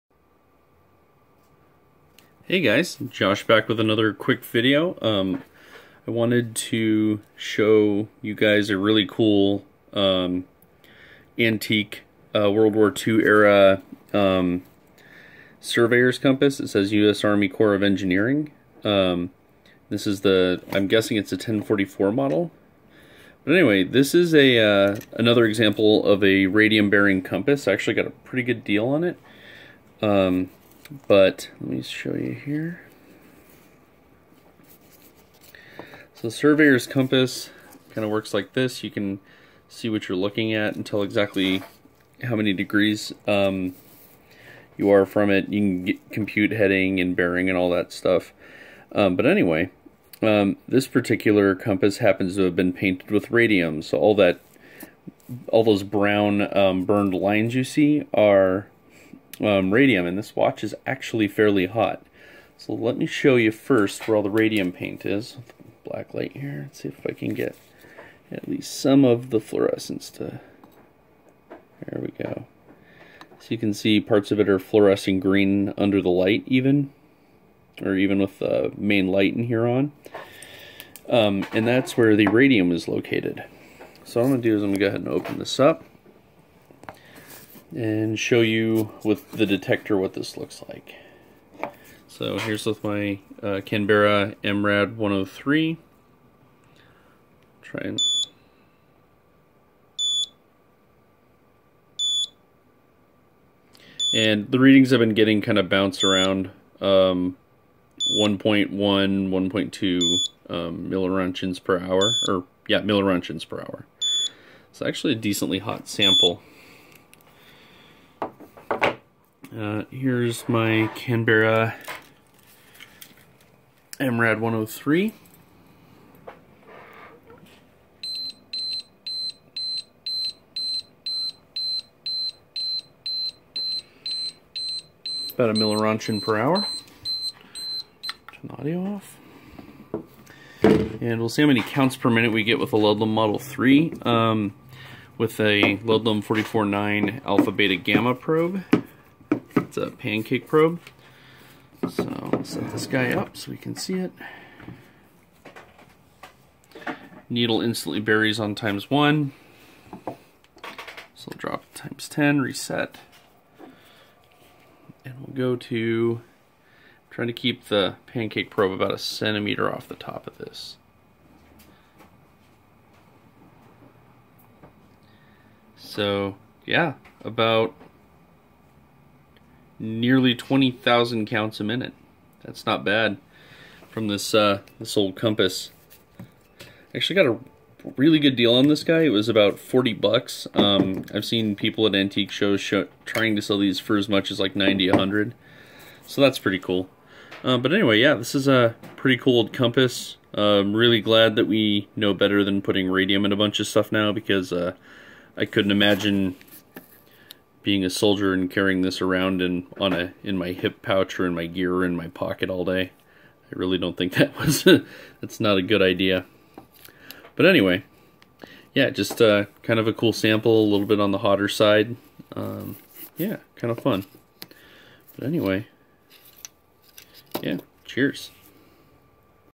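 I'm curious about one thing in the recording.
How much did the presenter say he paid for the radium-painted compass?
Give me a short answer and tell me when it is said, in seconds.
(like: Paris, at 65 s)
$40, at 189 s.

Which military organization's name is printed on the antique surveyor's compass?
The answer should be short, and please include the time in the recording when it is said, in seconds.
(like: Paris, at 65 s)
U.S. Army Corps of Engineering, at 16 s.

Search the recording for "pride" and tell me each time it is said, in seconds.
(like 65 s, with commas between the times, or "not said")
not said.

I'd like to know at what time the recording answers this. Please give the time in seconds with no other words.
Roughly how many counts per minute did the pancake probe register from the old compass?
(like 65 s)
180 s.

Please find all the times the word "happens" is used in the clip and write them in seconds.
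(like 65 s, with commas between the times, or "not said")
51 s.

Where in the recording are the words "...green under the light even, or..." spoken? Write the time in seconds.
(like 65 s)
75 s.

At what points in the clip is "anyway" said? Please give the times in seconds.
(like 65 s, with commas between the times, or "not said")
23 s, 49 s, 197 s, 217 s, 225 s.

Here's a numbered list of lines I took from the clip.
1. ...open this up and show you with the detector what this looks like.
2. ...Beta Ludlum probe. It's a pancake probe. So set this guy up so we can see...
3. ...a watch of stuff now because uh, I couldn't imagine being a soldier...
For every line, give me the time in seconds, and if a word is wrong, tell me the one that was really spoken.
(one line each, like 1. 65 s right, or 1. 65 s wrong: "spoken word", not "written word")
1. 85 s right
2. 147 s wrong: "Gamma", not "Ludlum"
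3. 203 s wrong: "bunch", not "watch".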